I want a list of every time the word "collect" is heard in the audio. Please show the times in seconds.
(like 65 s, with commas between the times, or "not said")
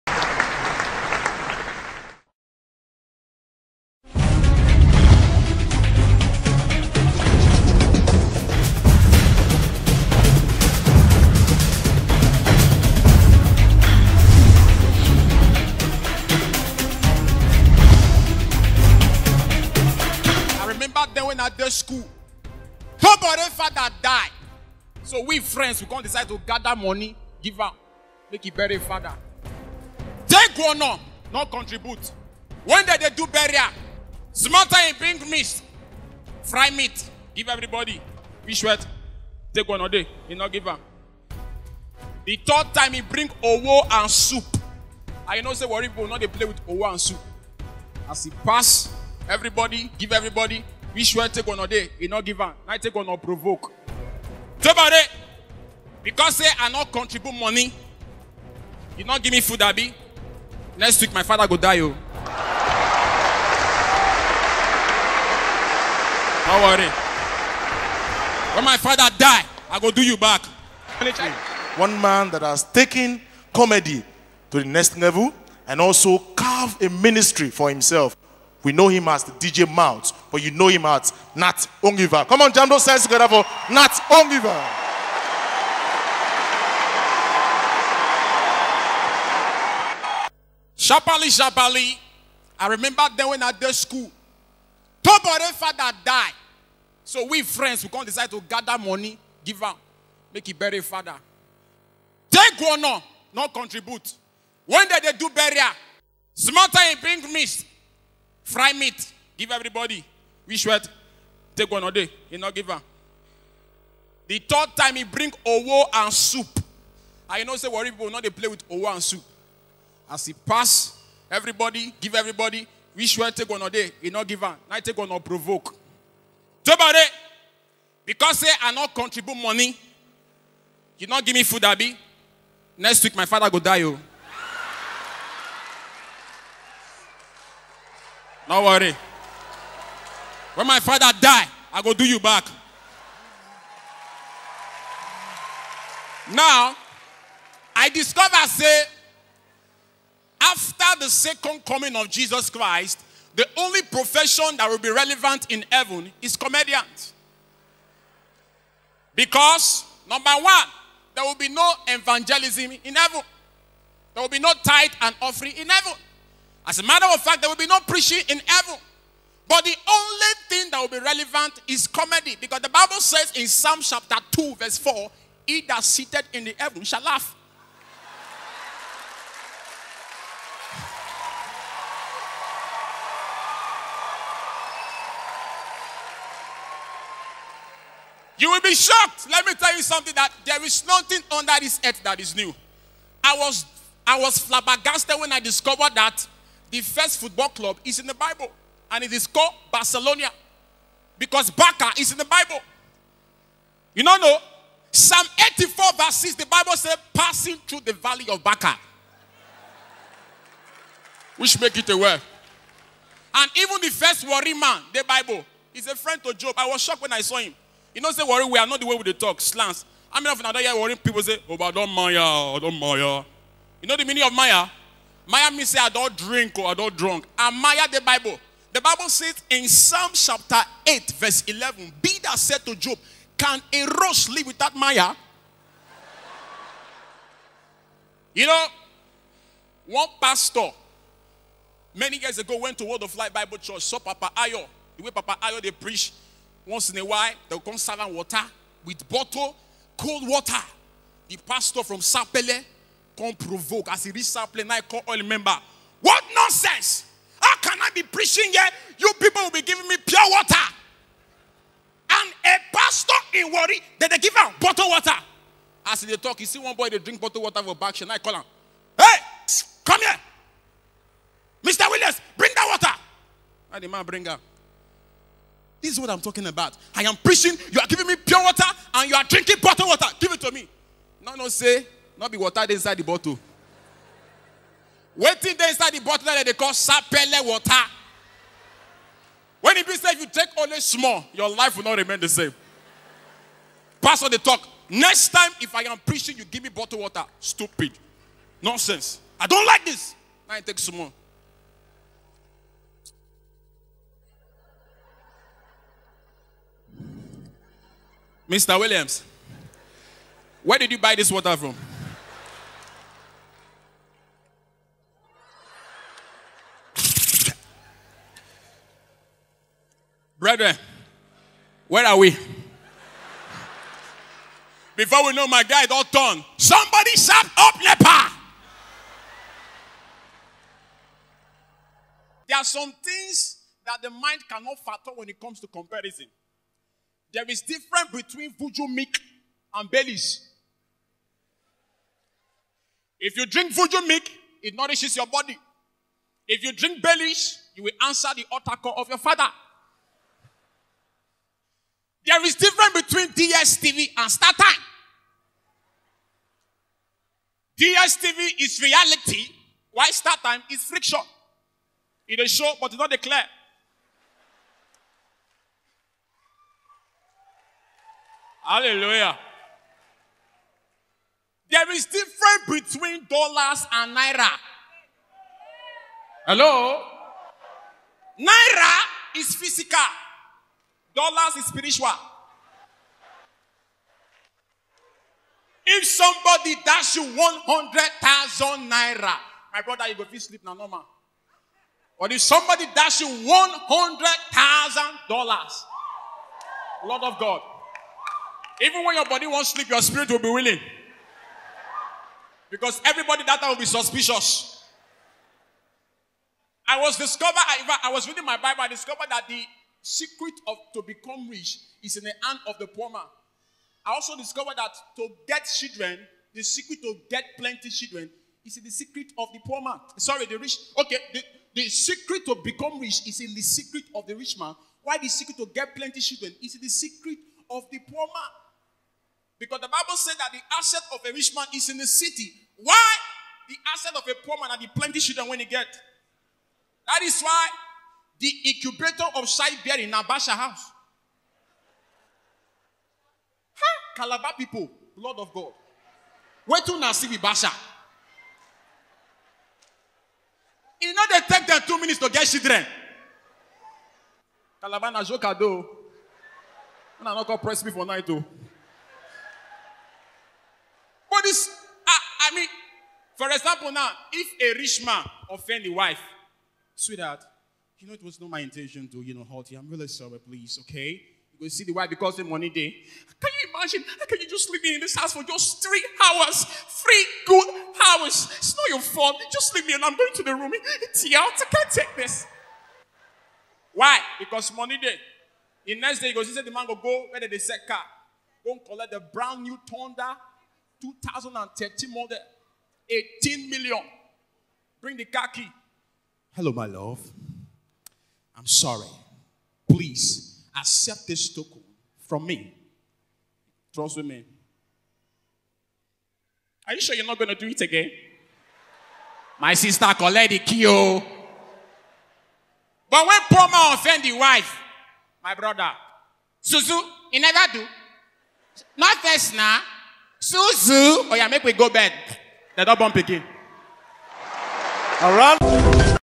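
488 s, 510 s.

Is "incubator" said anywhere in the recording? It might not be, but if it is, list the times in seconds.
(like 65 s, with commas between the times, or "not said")
438 s.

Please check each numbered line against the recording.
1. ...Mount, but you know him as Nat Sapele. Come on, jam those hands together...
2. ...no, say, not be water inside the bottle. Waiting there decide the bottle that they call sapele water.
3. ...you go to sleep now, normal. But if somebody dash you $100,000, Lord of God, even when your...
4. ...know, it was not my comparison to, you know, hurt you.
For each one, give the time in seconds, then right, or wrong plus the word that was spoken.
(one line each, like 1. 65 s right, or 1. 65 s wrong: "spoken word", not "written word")
1. 79 s wrong: "Oliver", not "Sapele"
2. 281 s wrong: "inside", not "decide"
3. 390 s right
4. 468 s wrong: "intention", not "comparison".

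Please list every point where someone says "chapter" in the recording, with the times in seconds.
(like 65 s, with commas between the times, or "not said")
173 s, 230 s.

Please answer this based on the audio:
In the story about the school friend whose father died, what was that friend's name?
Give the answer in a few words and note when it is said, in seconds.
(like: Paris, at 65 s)
Tobore, at 95 s.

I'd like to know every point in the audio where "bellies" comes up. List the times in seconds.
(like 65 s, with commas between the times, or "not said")
339 s, 347 s.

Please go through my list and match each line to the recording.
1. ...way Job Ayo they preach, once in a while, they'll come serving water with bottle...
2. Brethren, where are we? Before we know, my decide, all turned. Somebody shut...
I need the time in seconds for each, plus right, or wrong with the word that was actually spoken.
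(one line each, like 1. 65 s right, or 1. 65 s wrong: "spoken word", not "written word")
1. 245 s wrong: "Papa", not "Job"
2. 320 s wrong: "guide", not "decide".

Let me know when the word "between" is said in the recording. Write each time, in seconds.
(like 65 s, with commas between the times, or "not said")
338 s, 353 s, 372 s.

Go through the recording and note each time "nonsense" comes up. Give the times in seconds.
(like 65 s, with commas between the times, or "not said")
256 s, 298 s.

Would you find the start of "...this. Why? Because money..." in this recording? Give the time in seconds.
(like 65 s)
482 s.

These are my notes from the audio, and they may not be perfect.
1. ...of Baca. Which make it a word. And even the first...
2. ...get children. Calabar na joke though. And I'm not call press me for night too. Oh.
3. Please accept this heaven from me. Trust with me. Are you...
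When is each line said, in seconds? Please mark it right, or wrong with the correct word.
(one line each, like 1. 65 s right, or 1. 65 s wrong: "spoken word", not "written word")
1. 208 s right
2. 452 s right
3. 499 s wrong: "token", not "heaven".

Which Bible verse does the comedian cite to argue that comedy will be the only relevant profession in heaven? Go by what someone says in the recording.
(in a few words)
Psalm 2:4.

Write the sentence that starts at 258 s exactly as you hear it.
You people will be giving me pure water.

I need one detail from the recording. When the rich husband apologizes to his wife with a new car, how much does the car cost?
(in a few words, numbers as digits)
18 million.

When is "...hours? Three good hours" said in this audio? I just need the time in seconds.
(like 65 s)
476 s.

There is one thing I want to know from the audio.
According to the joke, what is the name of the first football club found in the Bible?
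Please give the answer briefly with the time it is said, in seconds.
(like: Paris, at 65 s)
Barcelona, at 199 s.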